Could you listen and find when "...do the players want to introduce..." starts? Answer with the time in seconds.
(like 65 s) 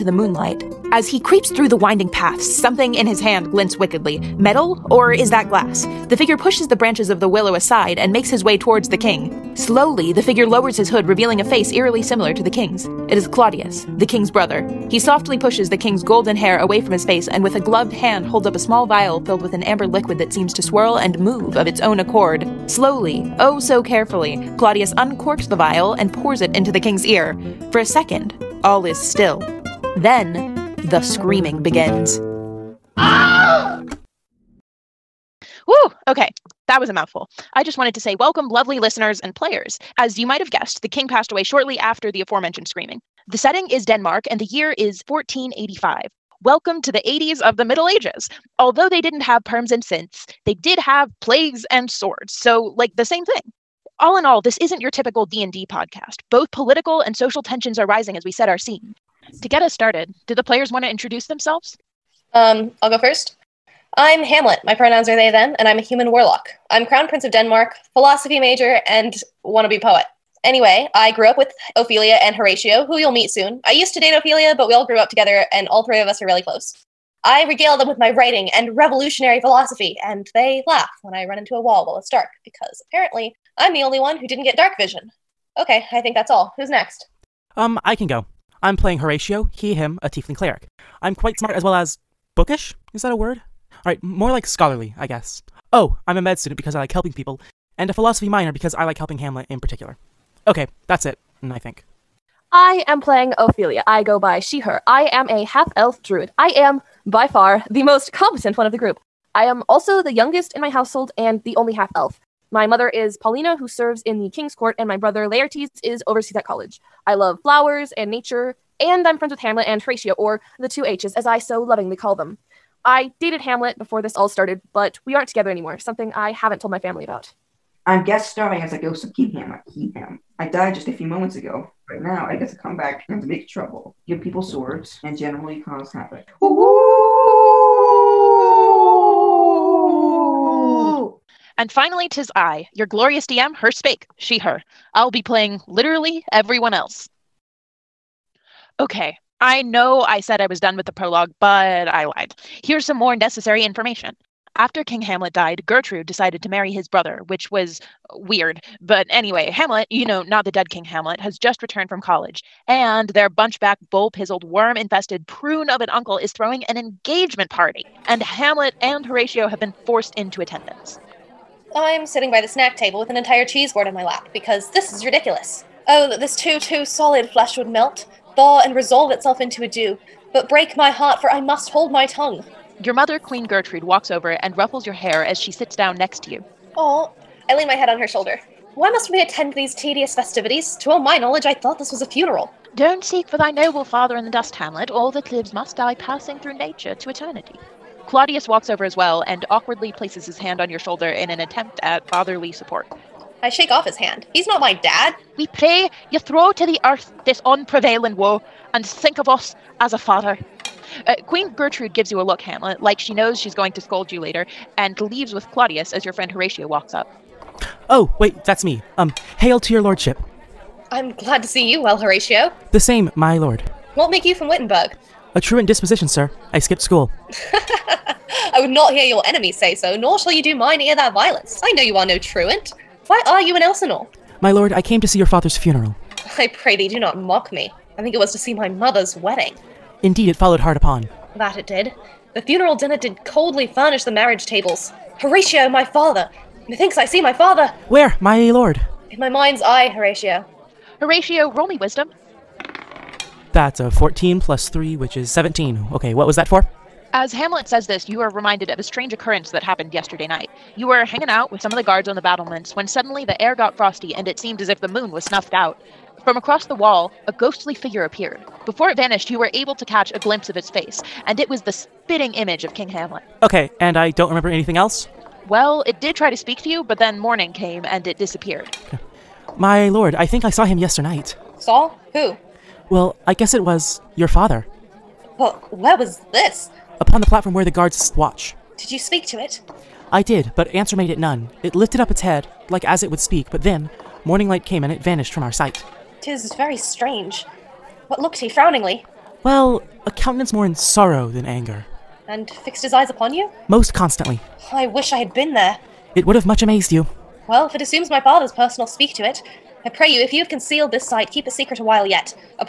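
60 s.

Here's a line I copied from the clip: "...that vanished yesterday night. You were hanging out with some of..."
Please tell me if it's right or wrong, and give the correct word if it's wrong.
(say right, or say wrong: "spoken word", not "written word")
wrong: "happened", not "vanished".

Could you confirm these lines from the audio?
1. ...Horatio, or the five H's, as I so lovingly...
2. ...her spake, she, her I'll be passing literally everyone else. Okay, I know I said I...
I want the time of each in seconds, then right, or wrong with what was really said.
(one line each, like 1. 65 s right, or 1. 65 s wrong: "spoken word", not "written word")
1. 119 s wrong: "two", not "five"
2. 143 s wrong: "playing", not "passing".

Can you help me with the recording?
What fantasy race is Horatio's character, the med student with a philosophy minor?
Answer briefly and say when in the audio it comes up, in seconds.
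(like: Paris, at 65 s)
tiefling, at 90 s.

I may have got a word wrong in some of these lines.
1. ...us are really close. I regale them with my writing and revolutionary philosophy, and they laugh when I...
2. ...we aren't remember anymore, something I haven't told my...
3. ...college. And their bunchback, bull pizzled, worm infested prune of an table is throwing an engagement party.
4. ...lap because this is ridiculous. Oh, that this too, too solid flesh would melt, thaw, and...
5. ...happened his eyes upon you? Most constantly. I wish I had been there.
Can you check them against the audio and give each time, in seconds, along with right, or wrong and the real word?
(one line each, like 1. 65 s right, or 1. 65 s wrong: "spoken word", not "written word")
1. 76 s right
2. 125 s wrong: "together", not "remember"
3. 162 s wrong: "uncle", not "table"
4. 174 s right
5. 302 s wrong: "fixed", not "happened".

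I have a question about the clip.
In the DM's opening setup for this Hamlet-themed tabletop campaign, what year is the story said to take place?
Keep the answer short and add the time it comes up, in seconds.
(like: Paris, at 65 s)
1485, at 45 s.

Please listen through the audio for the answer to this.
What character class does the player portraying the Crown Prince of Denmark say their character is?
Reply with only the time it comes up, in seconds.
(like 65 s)
66 s.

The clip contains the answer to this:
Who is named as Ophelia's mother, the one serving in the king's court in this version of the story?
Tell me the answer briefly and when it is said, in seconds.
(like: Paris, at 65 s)
Paulina, at 113 s.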